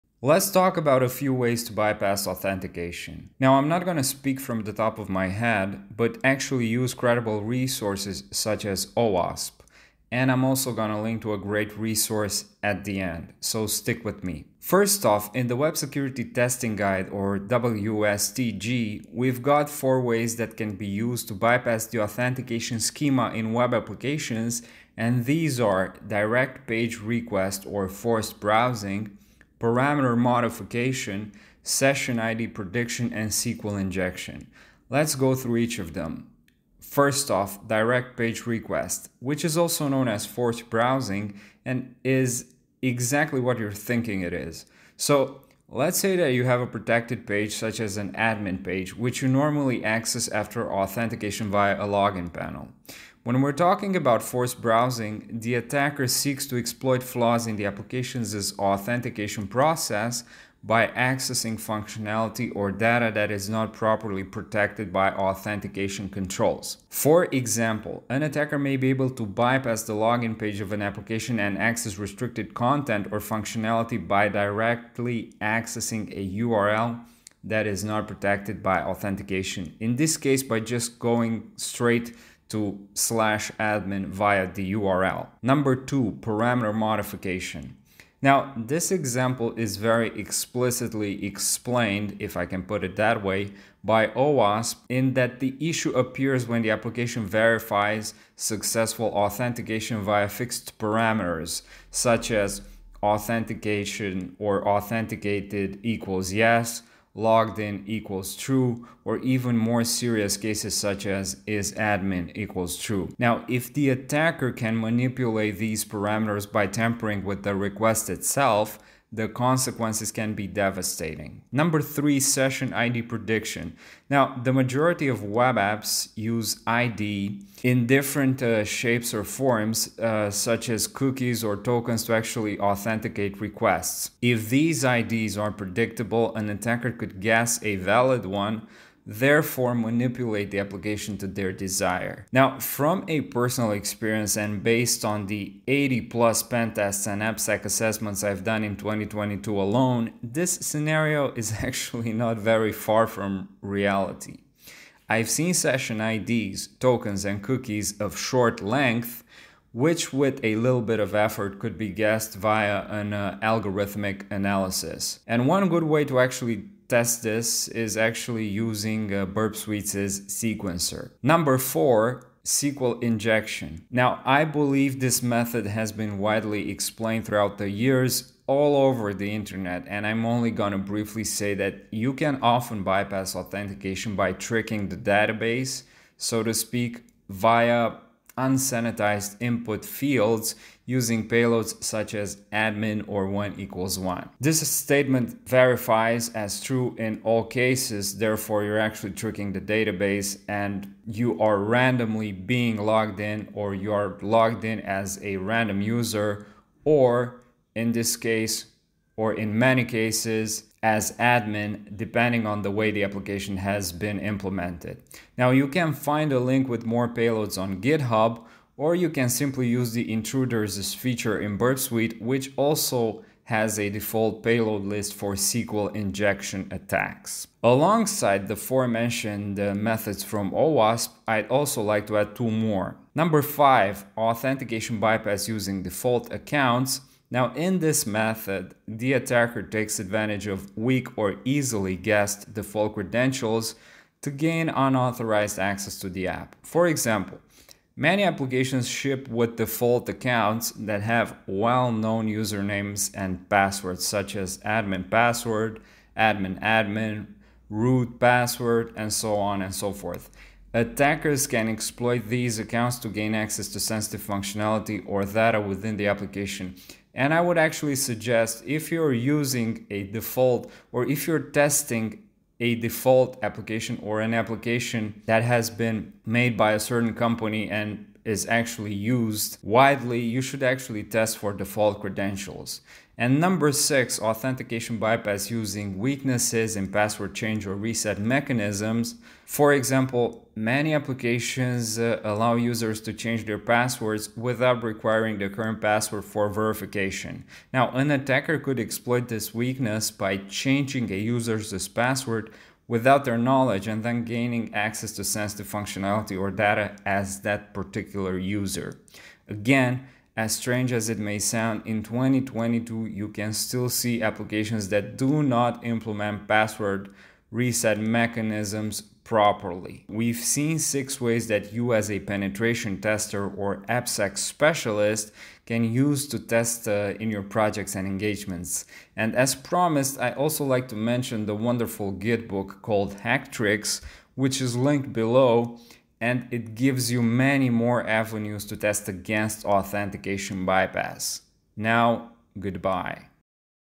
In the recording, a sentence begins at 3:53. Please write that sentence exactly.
Number five, authentication bypass using default accounts.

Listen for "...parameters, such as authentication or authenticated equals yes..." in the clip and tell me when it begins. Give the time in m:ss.
1:40.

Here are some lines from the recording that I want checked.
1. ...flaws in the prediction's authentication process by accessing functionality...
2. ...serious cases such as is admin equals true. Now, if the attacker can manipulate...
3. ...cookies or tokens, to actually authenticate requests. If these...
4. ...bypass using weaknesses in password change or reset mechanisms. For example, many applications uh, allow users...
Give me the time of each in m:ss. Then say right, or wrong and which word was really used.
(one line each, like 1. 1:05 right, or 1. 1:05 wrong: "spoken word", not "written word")
1. 0:57 wrong: "application", not "prediction"
2. 1:49 right
3. 2:10 right
4. 4:44 right.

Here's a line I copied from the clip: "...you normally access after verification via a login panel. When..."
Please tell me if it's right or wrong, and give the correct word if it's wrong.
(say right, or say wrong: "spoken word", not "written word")
wrong: "authentication", not "verification".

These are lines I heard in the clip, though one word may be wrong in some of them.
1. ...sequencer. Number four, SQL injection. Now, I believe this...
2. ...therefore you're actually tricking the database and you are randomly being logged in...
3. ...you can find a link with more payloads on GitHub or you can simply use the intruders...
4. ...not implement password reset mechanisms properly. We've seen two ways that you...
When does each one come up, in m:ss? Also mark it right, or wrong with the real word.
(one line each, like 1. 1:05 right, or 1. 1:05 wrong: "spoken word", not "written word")
1. 2:50 right
2. 3:18 right
3. 3:35 right
4. 5:15 wrong: "six", not "two".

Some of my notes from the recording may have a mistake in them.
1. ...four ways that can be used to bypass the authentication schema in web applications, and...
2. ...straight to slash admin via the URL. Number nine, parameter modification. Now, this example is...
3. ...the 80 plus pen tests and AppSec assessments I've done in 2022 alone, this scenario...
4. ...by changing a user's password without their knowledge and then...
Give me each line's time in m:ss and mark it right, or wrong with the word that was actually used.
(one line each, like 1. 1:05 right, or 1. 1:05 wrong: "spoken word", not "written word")
1. 0:19 right
2. 1:21 wrong: "two", not "nine"
3. 2:25 right
4. 5:00 right.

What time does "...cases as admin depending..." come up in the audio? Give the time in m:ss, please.
3:29.